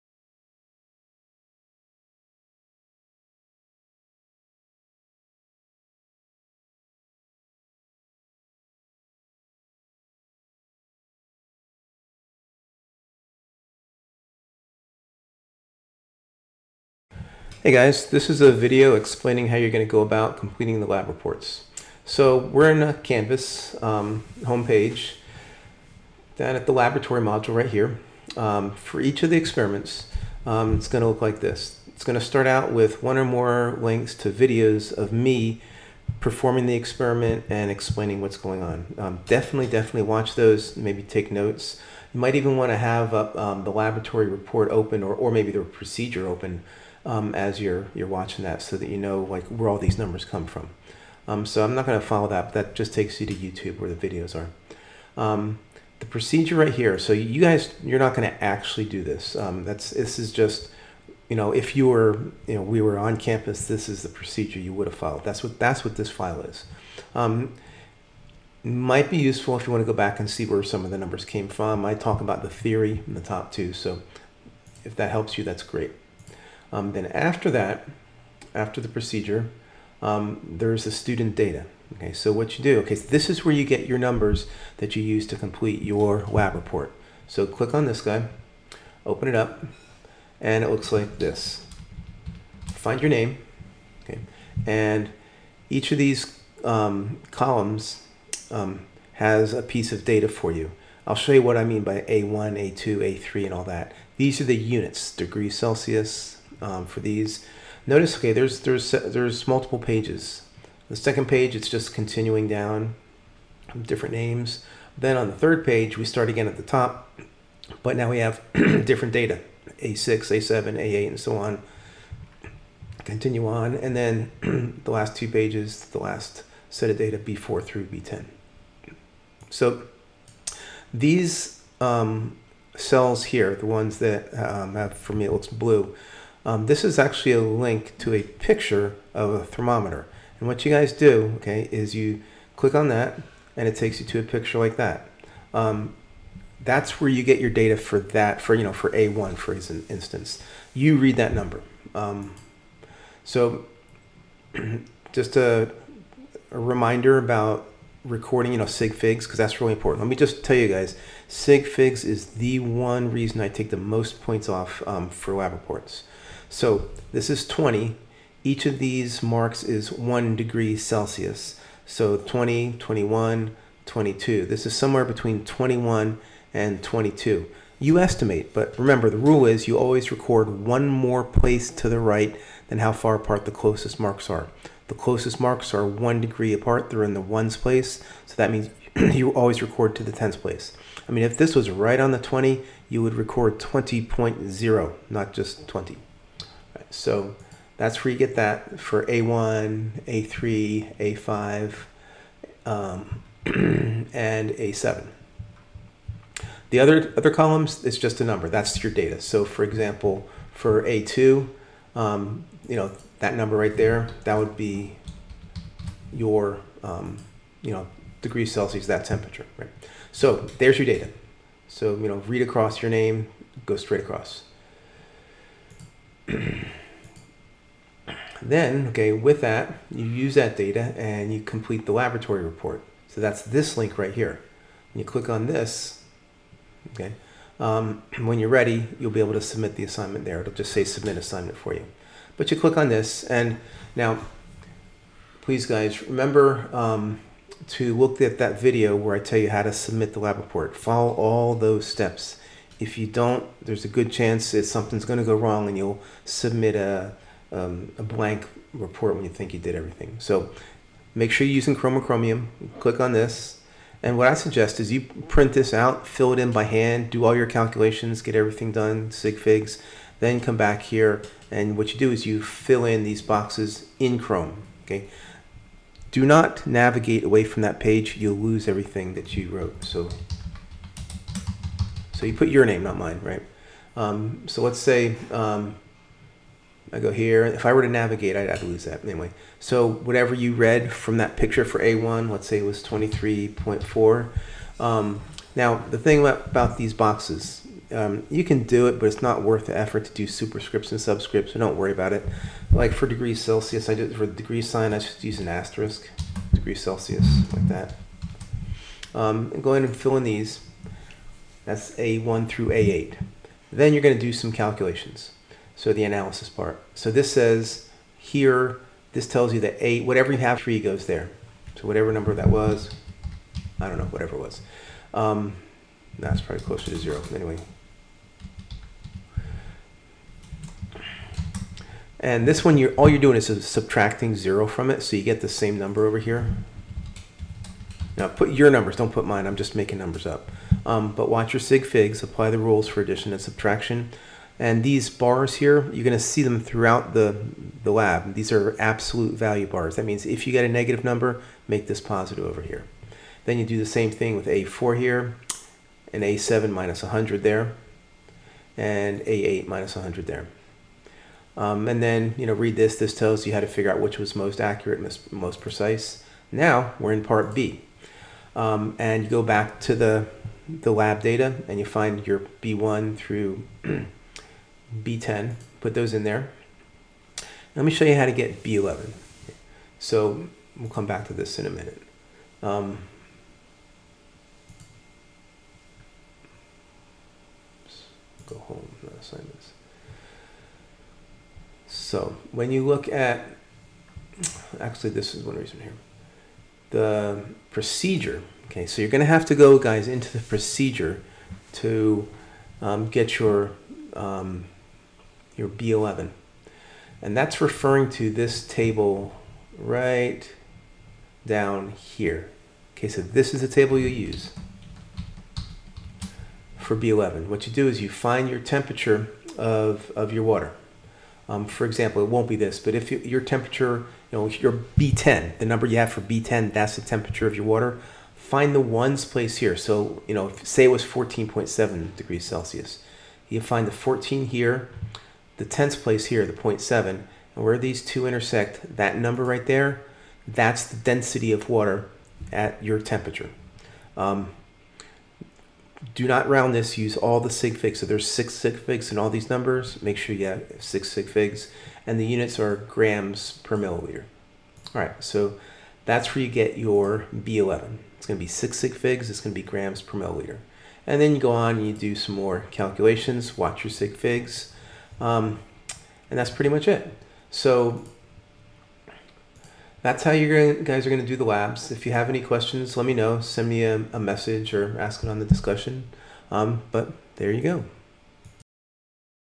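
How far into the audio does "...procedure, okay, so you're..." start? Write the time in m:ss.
6:37.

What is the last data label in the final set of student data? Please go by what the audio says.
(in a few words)
B10.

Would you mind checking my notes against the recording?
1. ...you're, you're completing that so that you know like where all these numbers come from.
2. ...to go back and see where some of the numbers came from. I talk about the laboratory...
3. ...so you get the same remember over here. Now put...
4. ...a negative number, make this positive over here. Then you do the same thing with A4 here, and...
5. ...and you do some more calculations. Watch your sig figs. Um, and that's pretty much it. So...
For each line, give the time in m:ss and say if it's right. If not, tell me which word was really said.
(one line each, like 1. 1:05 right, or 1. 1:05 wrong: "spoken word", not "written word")
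1. 0:47 wrong: "watching", not "completing"
2. 1:09 wrong: "theory", not "laboratory"
3. 5:35 wrong: "number", not "remember"
4. 5:50 right
5. 7:41 right.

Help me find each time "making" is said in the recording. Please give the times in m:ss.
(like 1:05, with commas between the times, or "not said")
5:39.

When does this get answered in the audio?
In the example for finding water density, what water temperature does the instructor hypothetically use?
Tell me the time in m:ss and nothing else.
7:11.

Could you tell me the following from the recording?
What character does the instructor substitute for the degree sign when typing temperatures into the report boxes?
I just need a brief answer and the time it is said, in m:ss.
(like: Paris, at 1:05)
An asterisk, at 5:05.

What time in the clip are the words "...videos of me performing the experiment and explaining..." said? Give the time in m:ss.
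0:34.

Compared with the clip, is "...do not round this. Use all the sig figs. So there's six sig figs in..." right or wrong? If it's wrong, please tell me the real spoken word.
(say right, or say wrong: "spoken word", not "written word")
right.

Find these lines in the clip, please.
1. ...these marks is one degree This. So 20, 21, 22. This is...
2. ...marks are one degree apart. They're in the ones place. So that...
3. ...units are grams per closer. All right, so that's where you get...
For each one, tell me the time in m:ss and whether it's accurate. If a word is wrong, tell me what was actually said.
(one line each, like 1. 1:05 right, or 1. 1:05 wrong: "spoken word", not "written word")
1. 2:48 wrong: "Celsius", not "This"
2. 3:05 right
3. 7:32 wrong: "milliliter", not "closer".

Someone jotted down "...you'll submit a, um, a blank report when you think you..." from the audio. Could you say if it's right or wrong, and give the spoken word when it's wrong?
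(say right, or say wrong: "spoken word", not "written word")
right.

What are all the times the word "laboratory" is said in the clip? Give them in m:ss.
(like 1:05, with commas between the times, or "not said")
0:26, 0:43, 3:51.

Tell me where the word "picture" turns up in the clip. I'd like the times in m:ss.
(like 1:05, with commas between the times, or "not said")
2:18, 2:24, 4:51.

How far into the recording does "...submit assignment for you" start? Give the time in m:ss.
4:00.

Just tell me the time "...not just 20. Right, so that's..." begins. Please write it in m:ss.
3:15.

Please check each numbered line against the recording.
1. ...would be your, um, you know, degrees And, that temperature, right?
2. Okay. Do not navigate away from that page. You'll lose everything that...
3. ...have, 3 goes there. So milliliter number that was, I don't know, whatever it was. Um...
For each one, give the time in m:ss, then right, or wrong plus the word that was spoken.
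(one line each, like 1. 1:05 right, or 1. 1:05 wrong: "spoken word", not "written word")
1. 3:34 wrong: "Celsius", not "And"
2. 4:34 right
3. 5:20 wrong: "whatever", not "milliliter".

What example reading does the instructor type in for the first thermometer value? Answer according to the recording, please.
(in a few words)
23.4.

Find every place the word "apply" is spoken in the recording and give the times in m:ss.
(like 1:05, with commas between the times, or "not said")
5:42.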